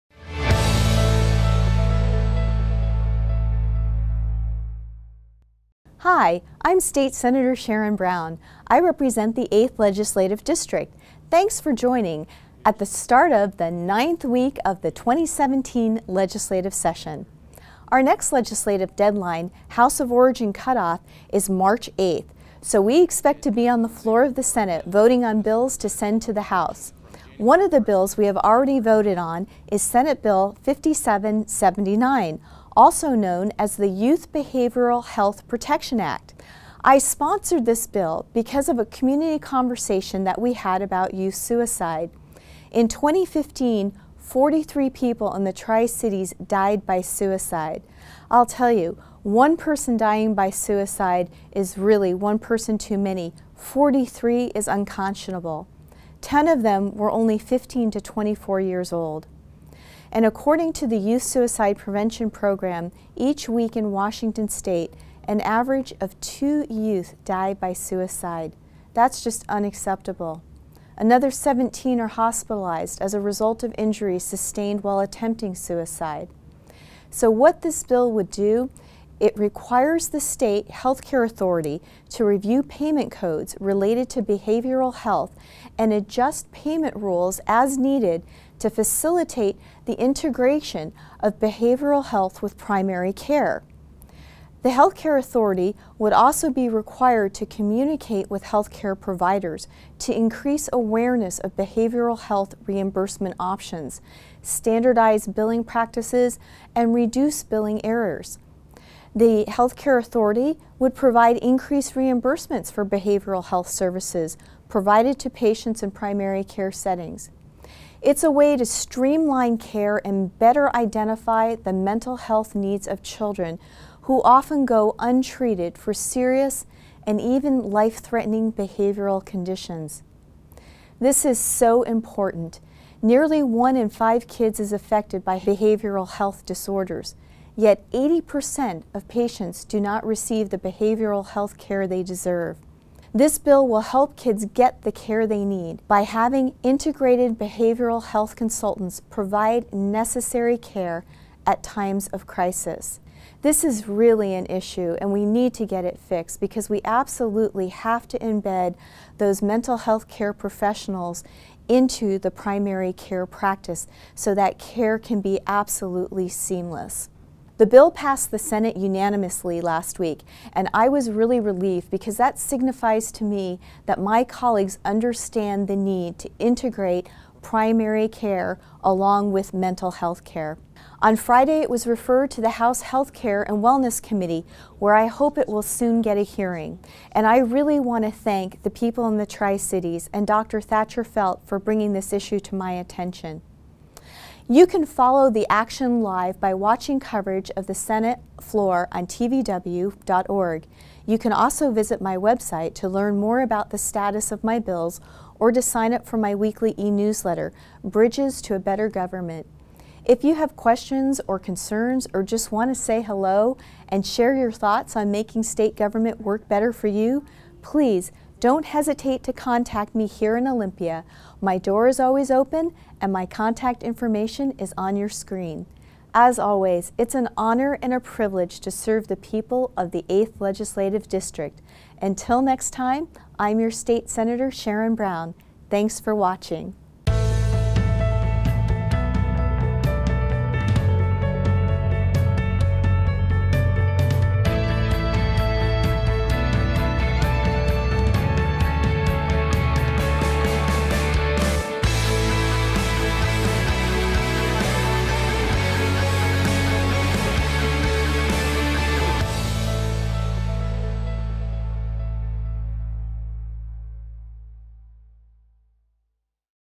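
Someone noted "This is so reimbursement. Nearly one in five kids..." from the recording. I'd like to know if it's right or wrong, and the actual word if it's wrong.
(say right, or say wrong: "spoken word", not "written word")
wrong: "important", not "reimbursement".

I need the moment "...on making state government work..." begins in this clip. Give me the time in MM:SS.
03:34.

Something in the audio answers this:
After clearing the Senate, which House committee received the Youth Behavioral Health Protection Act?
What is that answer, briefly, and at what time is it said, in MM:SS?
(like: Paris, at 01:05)
House Health Care and Wellness Committee, at 03:02.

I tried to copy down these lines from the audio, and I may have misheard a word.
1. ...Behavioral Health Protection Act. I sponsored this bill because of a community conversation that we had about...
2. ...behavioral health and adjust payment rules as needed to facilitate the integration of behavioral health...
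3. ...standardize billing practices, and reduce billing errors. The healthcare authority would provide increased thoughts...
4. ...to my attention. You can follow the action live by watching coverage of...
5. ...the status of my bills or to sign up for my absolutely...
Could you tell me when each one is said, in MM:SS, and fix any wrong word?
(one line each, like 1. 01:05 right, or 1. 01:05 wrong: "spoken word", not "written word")
1. 00:34 right
2. 01:24 right
3. 01:44 wrong: "reimbursements", not "thoughts"
4. 03:12 right
5. 03:23 wrong: "weekly", not "absolutely".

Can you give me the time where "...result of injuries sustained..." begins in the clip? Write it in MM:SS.
01:13.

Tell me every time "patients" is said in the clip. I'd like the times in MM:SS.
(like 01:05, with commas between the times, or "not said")
01:55, 02:19.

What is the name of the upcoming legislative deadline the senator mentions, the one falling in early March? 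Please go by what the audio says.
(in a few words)
House of Origin cutoff.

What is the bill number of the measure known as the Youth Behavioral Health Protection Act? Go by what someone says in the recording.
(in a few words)
5779.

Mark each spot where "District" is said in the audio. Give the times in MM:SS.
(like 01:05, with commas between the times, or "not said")
00:10, 03:51.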